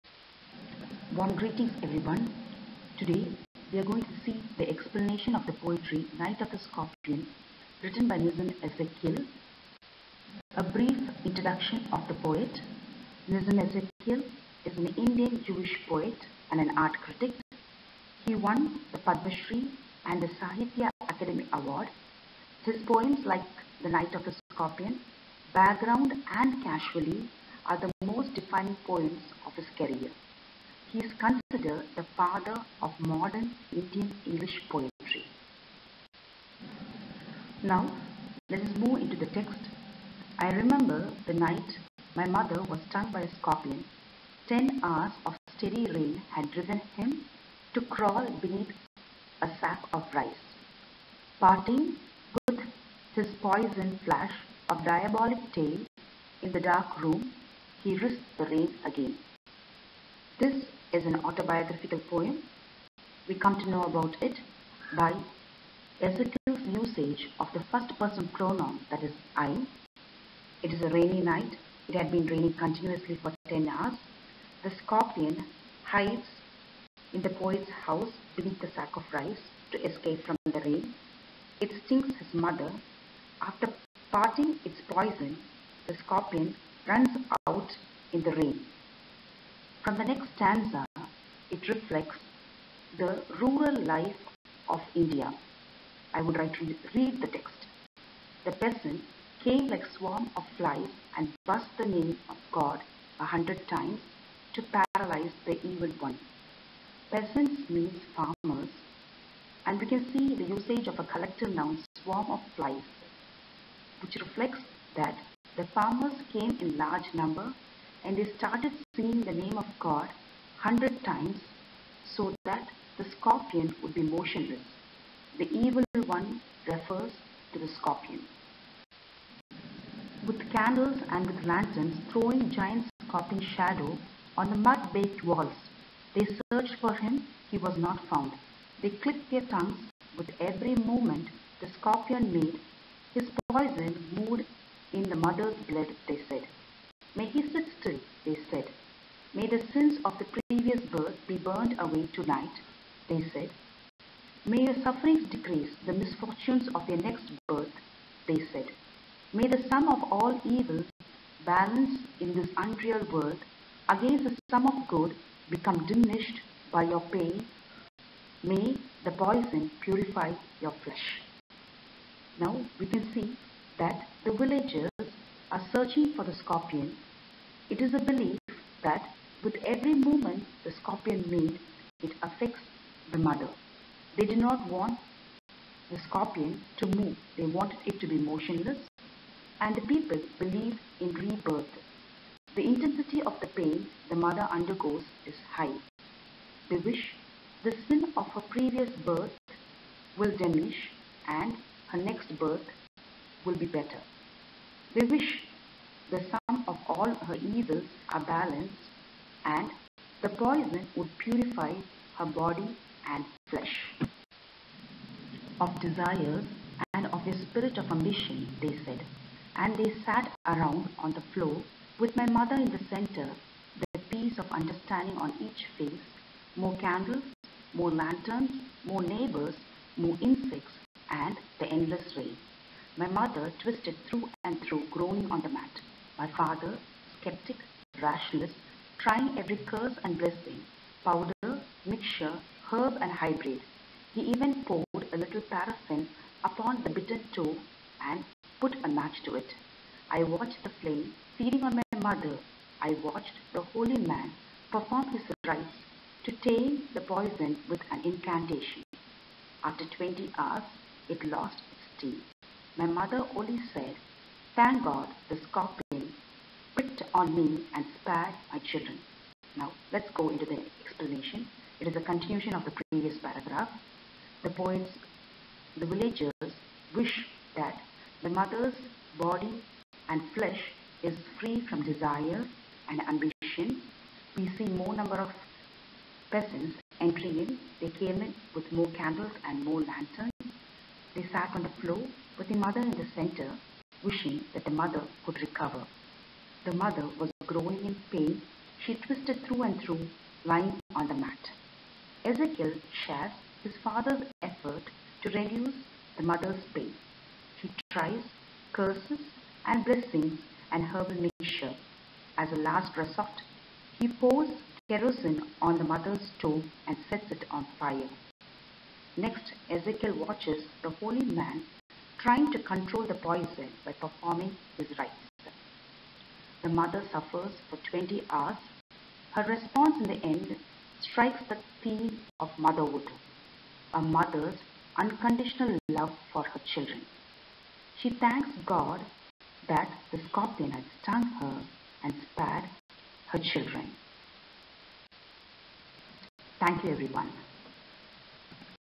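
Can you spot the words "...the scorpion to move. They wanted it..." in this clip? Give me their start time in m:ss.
3:05.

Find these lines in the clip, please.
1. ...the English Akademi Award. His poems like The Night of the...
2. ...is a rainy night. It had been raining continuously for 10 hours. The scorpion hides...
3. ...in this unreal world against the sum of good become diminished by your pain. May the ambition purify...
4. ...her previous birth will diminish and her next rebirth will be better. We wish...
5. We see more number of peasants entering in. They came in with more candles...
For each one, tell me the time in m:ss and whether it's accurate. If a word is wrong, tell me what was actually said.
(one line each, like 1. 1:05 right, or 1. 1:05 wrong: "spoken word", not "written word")
1. 0:20 wrong: "Sahitya", not "English"
2. 1:10 right
3. 2:42 wrong: "poison", not "ambition"
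4. 3:18 wrong: "birth", not "rebirth"
5. 4:44 right.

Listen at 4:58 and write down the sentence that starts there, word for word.
She twisted through and through, lying on the mat.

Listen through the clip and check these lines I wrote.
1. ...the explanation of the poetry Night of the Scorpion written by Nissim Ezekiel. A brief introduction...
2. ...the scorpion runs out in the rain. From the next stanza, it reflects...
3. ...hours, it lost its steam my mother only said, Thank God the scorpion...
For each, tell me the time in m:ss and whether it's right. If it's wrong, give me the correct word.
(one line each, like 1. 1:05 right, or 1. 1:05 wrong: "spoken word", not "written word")
1. 0:04 right
2. 1:25 right
3. 4:20 right.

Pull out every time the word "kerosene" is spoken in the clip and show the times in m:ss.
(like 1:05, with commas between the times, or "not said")
5:14.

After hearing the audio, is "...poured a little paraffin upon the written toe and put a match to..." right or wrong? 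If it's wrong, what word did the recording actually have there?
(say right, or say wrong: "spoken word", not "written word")
wrong: "bitten", not "written".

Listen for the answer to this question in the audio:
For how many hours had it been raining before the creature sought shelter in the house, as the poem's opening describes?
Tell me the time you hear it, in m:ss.
0:44.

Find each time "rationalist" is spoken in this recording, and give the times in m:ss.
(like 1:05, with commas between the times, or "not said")
3:58.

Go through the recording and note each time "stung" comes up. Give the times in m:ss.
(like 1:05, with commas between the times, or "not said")
0:42, 5:41.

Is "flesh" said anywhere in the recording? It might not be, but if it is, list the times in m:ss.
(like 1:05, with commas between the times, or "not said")
2:50, 3:33, 4:40.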